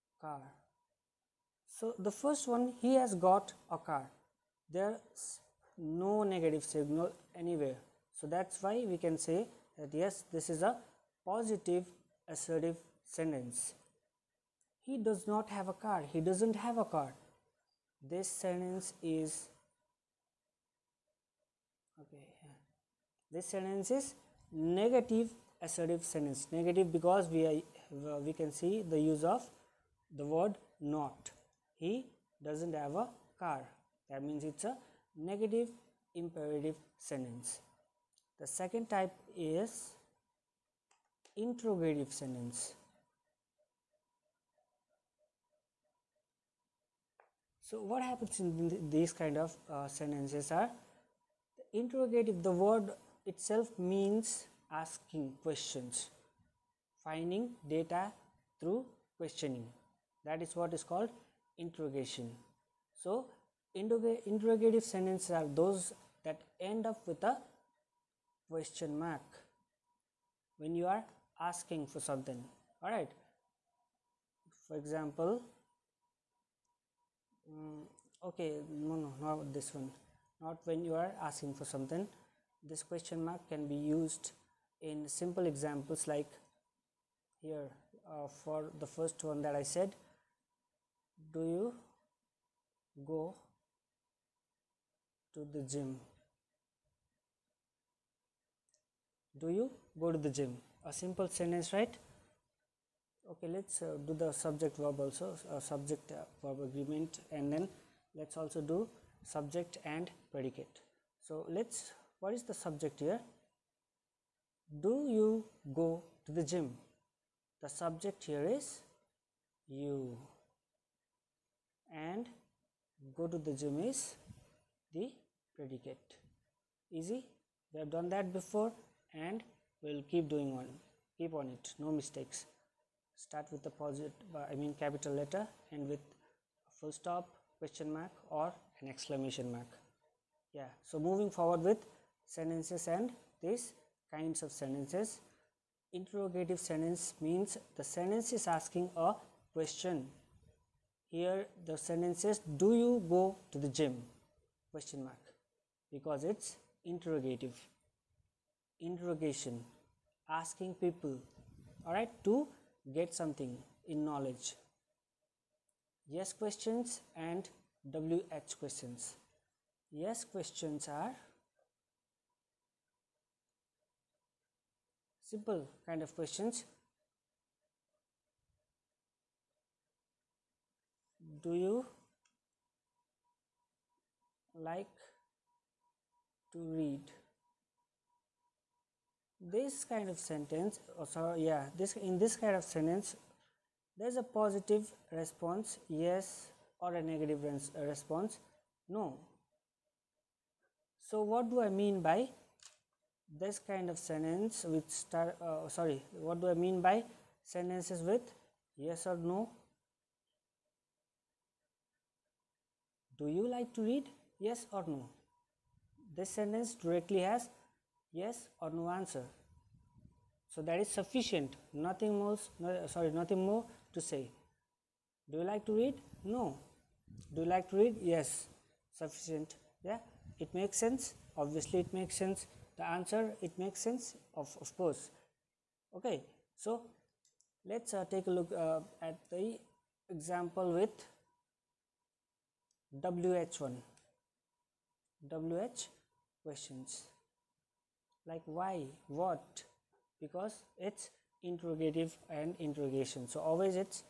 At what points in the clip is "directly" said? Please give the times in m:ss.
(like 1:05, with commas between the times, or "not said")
3:36.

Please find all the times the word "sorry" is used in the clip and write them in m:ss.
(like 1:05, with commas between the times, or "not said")
3:25, 3:42.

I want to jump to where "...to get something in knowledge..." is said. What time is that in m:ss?
2:42.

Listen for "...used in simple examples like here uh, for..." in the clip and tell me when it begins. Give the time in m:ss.
1:23.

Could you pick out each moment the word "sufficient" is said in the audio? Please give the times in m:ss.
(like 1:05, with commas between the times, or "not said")
3:40, 3:48.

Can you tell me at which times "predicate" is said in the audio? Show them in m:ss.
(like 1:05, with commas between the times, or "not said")
1:50, 2:05.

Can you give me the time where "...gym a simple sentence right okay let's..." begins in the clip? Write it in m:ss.
1:40.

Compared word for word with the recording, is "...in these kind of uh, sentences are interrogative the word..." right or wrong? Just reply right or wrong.
right.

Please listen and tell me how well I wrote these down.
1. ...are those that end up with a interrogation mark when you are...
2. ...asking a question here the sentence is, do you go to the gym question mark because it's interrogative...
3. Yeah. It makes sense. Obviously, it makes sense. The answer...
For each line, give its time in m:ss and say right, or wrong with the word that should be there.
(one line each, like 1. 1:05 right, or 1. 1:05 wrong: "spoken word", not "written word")
1. 1:05 wrong: "question", not "interrogation"
2. 2:28 right
3. 3:49 right.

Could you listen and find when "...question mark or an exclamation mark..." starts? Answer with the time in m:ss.
2:17.